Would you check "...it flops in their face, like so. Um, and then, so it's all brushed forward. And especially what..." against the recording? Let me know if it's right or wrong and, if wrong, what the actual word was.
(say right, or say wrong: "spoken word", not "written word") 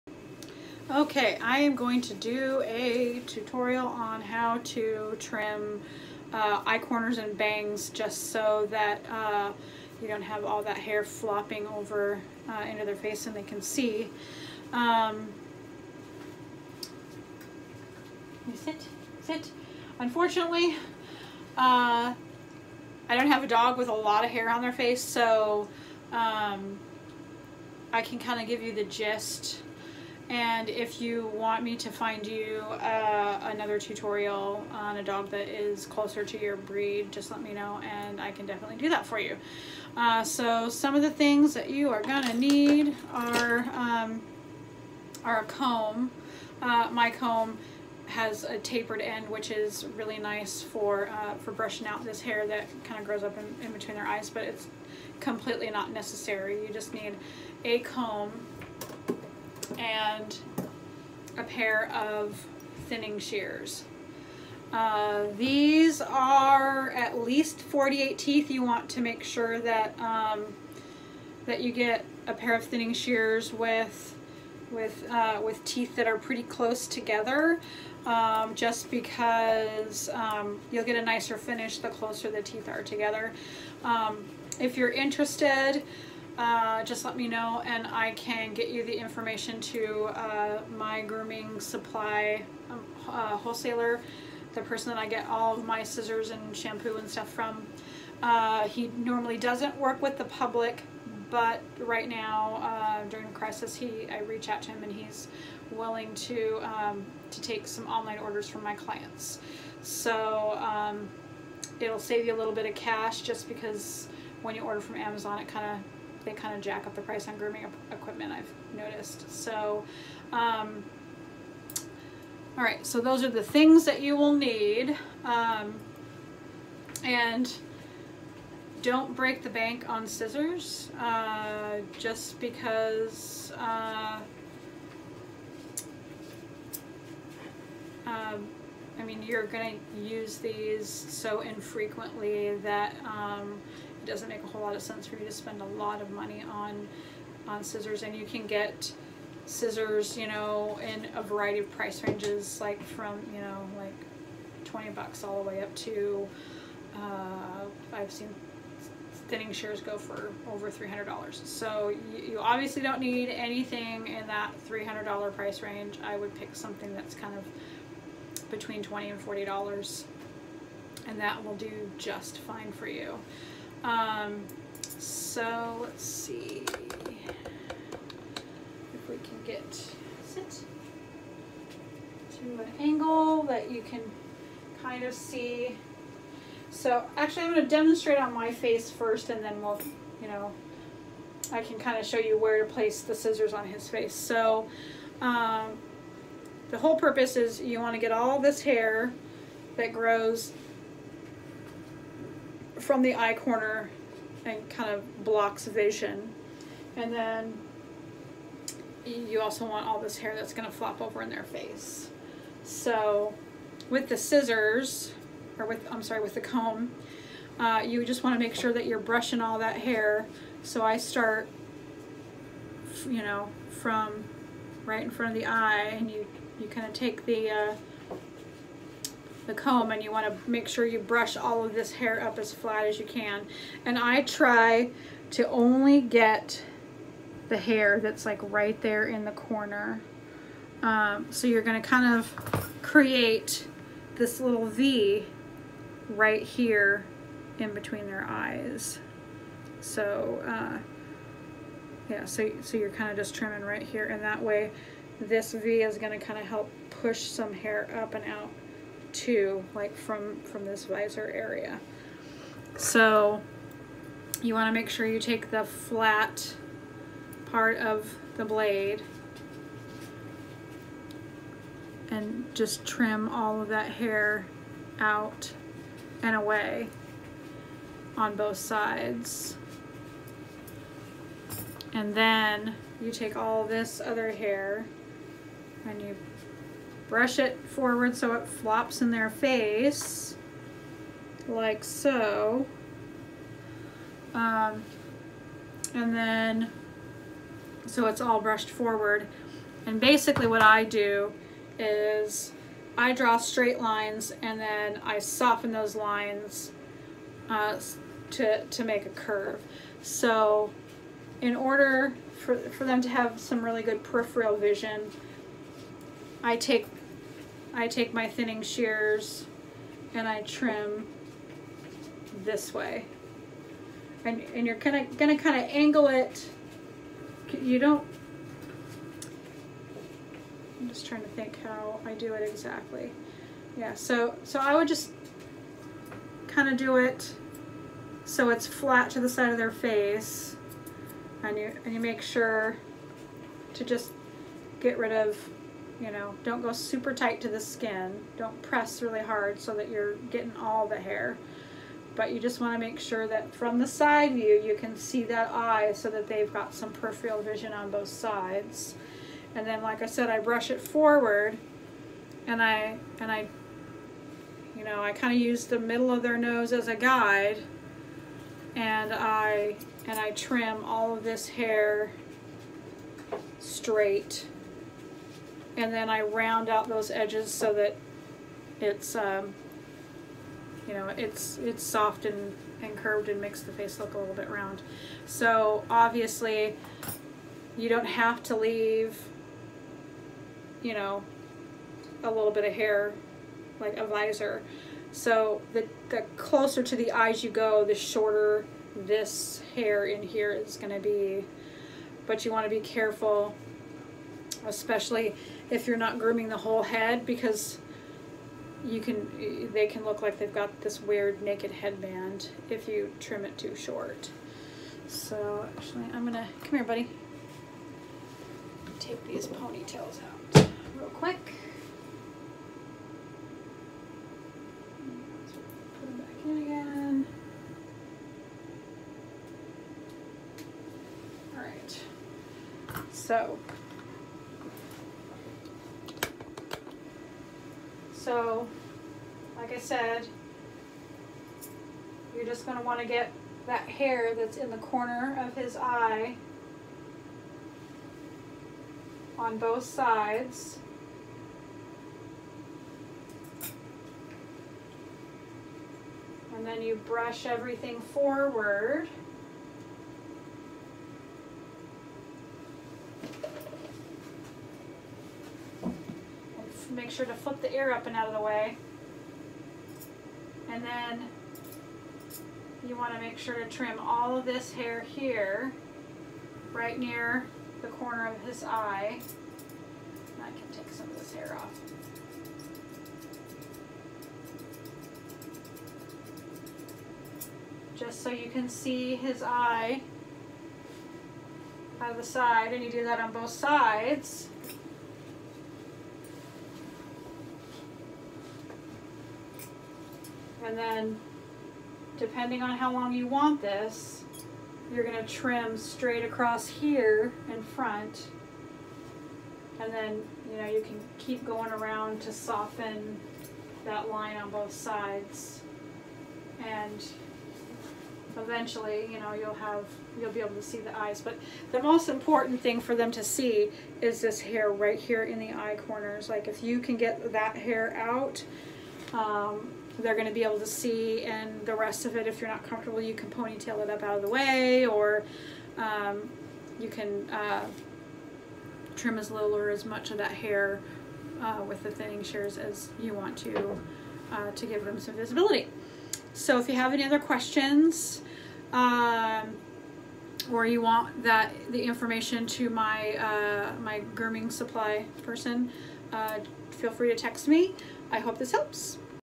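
wrong: "basically", not "especially".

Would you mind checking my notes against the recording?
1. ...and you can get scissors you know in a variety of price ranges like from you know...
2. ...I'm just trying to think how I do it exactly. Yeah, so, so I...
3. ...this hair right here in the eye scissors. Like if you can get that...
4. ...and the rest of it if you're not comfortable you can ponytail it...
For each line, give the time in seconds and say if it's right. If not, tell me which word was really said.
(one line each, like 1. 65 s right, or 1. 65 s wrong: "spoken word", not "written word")
1. 148 s right
2. 330 s right
3. 524 s wrong: "corners", not "scissors"
4. 531 s right.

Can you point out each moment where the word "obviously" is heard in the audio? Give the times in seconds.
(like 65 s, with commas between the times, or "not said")
162 s, 385 s.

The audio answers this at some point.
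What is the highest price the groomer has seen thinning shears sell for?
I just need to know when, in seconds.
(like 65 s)
160 s.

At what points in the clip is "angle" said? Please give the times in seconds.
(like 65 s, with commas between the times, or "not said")
182 s, 325 s.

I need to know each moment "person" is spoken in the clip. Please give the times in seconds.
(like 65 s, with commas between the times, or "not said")
94 s, 555 s.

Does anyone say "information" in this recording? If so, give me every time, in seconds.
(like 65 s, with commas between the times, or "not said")
88 s, 551 s.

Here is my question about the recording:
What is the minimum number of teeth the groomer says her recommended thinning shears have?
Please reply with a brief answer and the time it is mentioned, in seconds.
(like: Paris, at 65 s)
48, at 67 s.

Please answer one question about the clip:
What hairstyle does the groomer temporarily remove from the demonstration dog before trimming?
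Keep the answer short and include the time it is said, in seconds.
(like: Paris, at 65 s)
Ponytails, at 419 s.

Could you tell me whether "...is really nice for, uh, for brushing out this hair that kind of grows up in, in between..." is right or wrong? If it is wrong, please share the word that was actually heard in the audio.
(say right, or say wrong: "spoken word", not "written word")
right.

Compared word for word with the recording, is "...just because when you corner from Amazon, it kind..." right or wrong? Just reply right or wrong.
wrong.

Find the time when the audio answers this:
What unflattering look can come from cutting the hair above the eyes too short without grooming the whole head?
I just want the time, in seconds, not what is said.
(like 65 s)
411 s.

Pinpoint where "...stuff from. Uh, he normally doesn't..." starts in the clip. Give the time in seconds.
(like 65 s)
97 s.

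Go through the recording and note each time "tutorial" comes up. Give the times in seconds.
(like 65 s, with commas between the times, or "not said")
3 s, 33 s.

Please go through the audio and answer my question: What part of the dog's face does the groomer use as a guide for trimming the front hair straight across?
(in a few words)
Middle of their nose.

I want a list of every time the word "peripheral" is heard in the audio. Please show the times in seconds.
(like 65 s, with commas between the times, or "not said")
314 s, 356 s.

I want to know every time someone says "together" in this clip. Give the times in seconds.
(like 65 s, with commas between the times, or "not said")
76 s, 82 s.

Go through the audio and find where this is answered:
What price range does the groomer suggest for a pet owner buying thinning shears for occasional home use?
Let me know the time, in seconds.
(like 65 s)
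168 s.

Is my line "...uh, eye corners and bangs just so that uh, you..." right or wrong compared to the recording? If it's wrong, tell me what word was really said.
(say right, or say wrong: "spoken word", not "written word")
right.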